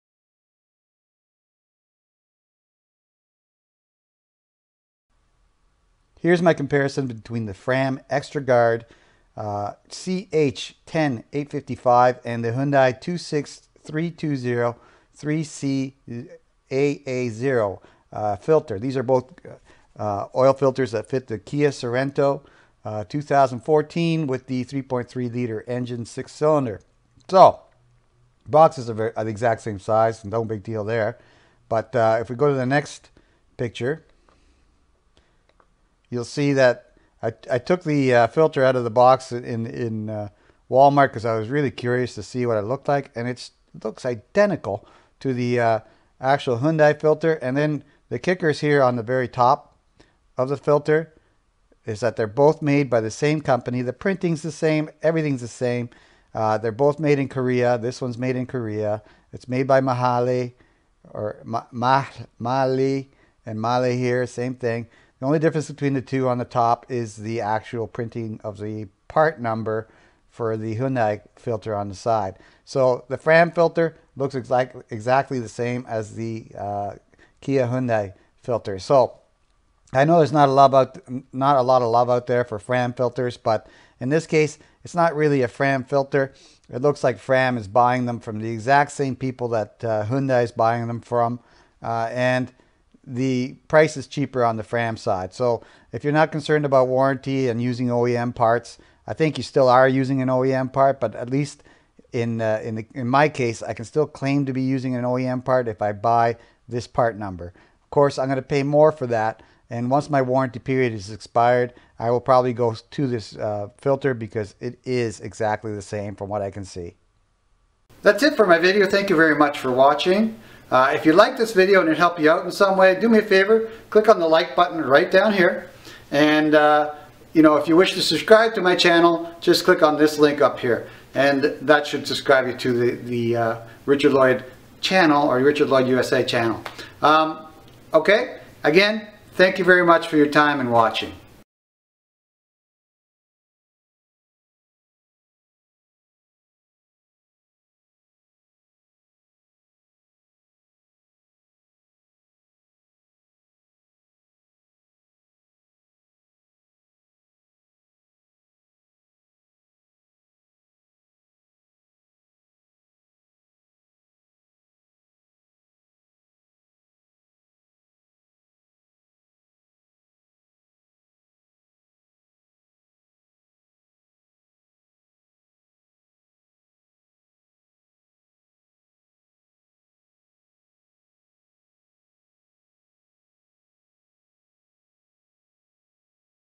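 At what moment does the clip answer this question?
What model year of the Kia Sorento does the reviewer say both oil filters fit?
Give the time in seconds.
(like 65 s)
23 s.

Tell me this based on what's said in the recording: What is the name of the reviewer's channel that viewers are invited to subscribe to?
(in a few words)
Richard Lloyd USA.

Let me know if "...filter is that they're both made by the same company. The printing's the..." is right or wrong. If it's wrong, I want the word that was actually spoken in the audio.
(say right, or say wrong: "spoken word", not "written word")
right.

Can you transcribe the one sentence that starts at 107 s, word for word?
Of course, I'm going to pay more for that.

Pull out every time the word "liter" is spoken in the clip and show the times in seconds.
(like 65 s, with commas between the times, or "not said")
25 s.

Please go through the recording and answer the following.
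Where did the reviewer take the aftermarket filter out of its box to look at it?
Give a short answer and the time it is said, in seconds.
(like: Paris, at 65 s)
Walmart, at 40 s.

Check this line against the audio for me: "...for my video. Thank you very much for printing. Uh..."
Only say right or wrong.
wrong.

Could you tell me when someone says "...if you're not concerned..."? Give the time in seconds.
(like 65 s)
95 s.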